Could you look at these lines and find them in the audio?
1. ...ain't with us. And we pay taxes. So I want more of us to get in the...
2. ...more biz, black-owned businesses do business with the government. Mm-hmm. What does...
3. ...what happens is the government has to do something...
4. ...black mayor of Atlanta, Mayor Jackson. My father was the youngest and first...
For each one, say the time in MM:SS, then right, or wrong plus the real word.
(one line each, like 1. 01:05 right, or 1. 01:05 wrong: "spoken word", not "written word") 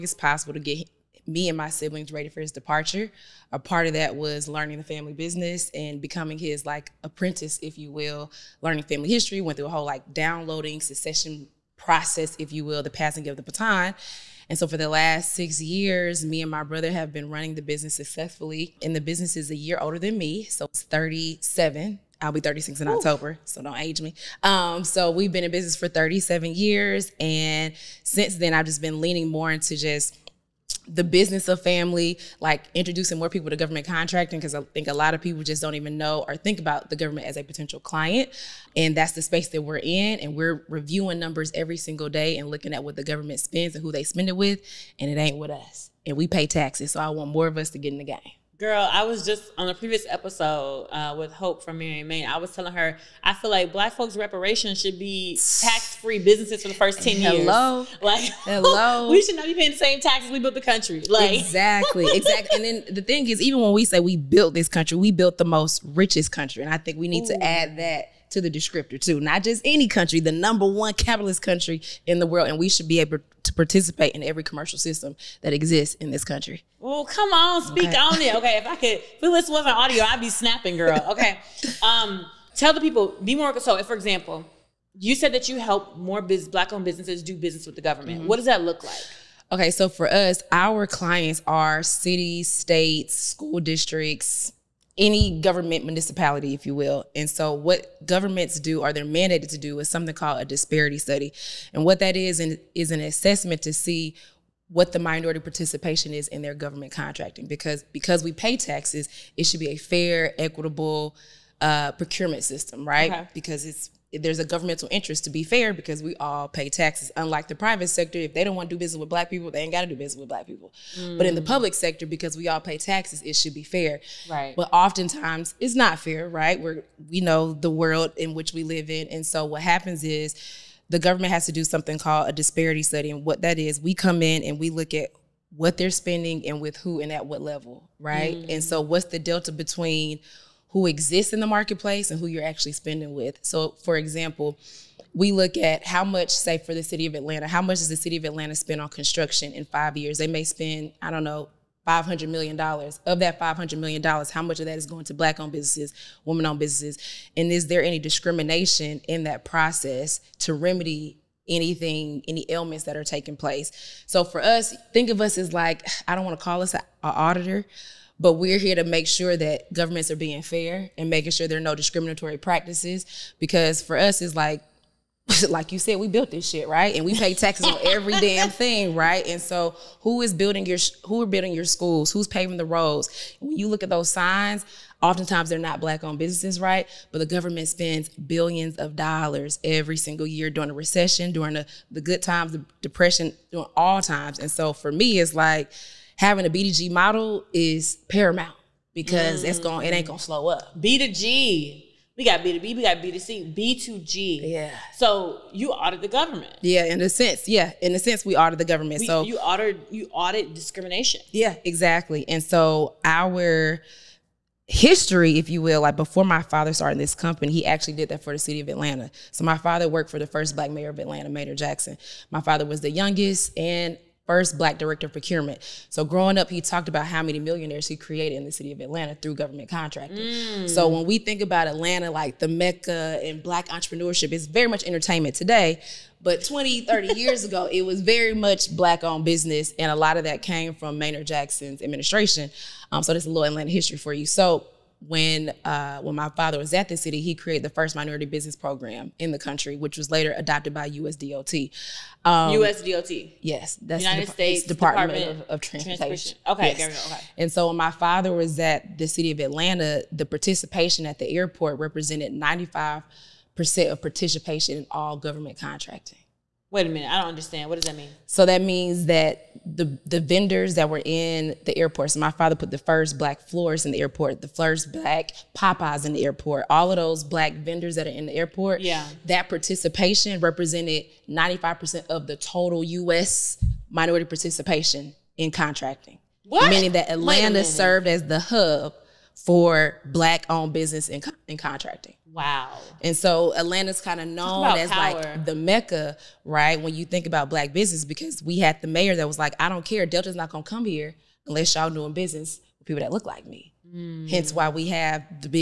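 1. 00:45 right
2. 01:25 right
3. 02:09 right
4. 03:40 right.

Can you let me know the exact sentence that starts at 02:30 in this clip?
They may spend, I don't know, $500 million.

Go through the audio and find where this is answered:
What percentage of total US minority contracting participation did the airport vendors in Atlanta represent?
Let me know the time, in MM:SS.
04:41.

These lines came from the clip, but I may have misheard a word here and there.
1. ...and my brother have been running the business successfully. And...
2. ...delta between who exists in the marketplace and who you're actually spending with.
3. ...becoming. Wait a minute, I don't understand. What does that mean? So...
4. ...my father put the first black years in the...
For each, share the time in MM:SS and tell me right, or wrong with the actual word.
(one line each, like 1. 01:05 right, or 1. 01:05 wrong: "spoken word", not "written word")
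1. 00:16 right
2. 02:19 right
3. 04:25 wrong: "contracting", not "becoming"
4. 04:32 wrong: "floors", not "years".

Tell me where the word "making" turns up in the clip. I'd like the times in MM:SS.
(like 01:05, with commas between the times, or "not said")
02:51.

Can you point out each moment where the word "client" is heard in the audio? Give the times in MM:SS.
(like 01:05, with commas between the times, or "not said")
00:37, 01:30.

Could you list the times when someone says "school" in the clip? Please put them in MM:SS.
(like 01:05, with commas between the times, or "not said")
01:33, 03:01.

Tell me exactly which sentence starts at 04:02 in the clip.
Um, so this is a little Atlanta history for you.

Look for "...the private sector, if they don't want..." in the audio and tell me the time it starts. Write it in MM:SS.
01:57.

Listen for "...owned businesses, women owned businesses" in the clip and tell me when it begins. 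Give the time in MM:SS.
02:35.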